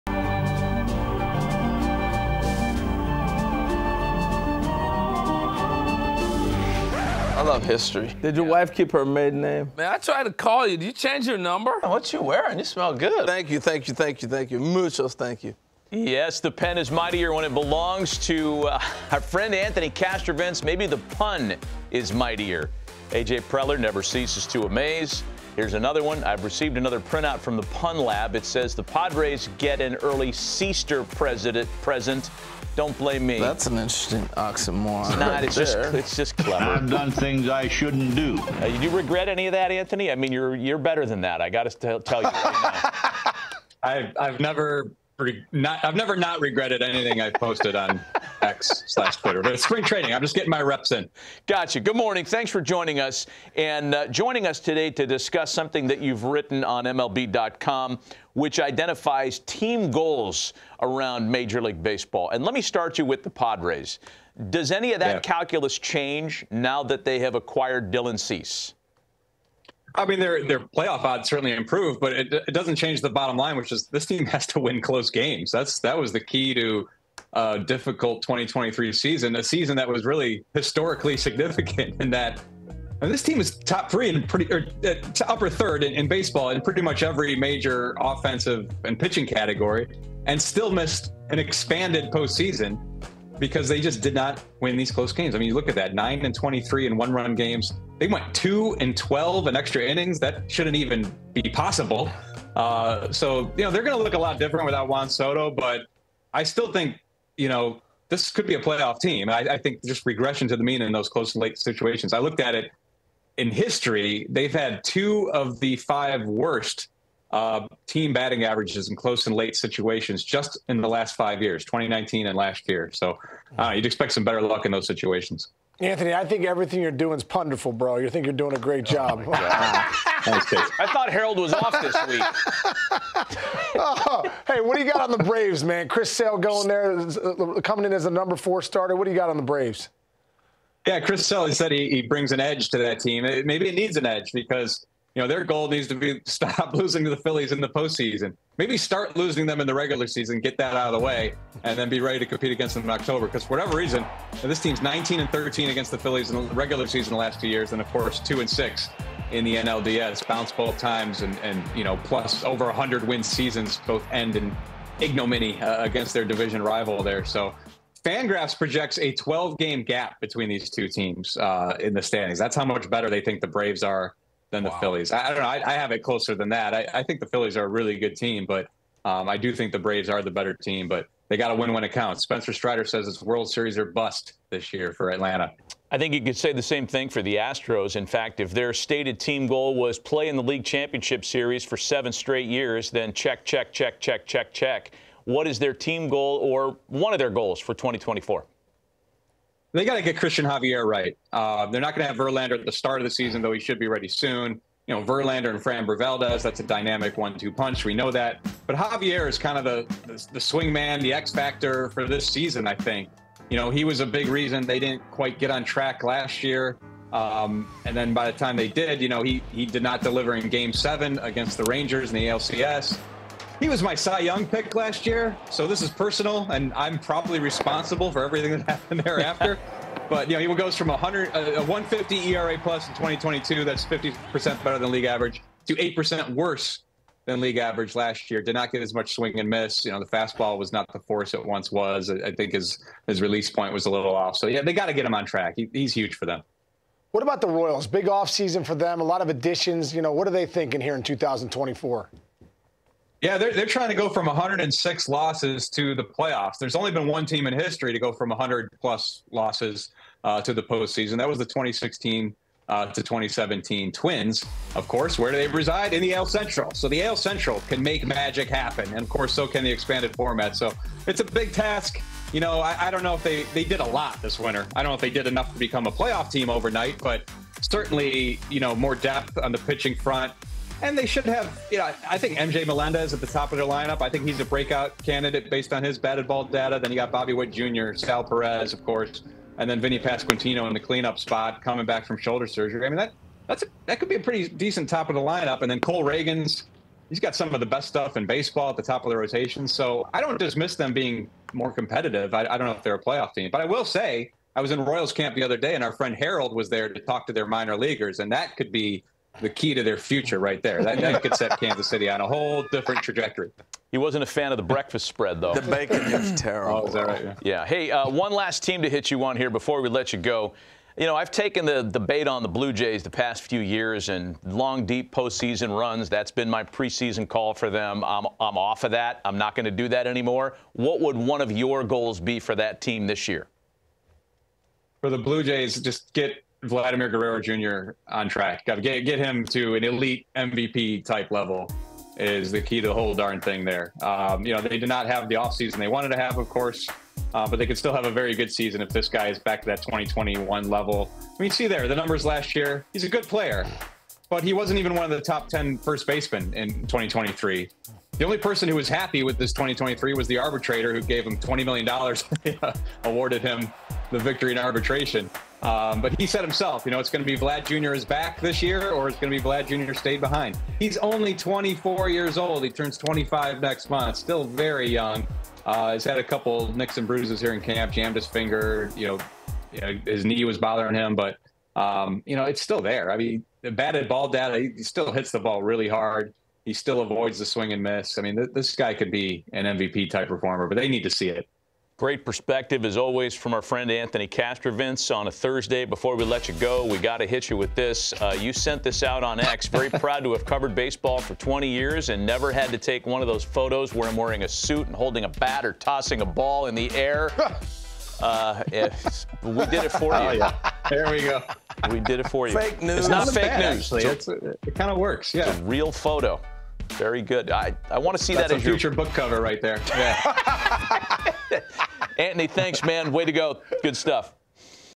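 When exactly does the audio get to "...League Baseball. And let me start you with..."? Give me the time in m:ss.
1:01.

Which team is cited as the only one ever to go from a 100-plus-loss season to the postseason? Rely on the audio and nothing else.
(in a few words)
2016-2017 Twins.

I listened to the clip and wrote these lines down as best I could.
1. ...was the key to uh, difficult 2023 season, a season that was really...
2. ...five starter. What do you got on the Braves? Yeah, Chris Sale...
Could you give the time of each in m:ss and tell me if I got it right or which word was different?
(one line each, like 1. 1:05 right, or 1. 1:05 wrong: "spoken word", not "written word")
1. 1:15 right
2. 2:18 wrong: "four", not "five".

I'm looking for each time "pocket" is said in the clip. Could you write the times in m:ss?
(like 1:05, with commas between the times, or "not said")
not said.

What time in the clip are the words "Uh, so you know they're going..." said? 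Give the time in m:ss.
1:42.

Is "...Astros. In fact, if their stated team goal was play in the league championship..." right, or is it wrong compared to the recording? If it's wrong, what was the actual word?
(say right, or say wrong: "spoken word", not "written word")
right.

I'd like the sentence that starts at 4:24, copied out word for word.
Of course, where do they reside?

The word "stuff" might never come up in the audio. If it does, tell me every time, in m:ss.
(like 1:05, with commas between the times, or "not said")
4:57, 7:03.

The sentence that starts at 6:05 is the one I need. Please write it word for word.
Um, but he said himself, you know, it's going to be Vlad Jr.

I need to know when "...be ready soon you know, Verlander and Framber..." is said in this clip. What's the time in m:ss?
3:23.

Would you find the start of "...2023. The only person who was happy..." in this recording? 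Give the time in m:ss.
5:56.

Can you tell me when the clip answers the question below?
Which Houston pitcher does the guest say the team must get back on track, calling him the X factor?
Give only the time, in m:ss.
3:20.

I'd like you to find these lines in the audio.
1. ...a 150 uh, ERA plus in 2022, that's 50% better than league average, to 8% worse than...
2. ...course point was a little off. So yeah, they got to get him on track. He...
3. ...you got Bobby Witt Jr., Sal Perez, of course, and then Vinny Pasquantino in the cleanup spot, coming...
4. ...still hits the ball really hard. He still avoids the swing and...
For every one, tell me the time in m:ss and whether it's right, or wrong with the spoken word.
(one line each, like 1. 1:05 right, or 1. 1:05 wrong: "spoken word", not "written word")
1. 3:51 right
2. 4:03 wrong: "release", not "course"
3. 4:46 right
4. 6:24 right.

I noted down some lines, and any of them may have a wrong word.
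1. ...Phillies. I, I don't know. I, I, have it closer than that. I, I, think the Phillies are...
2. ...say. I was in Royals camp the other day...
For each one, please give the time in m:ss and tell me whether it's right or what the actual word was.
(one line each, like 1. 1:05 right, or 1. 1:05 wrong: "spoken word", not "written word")
1. 2:54 right
2. 5:03 right.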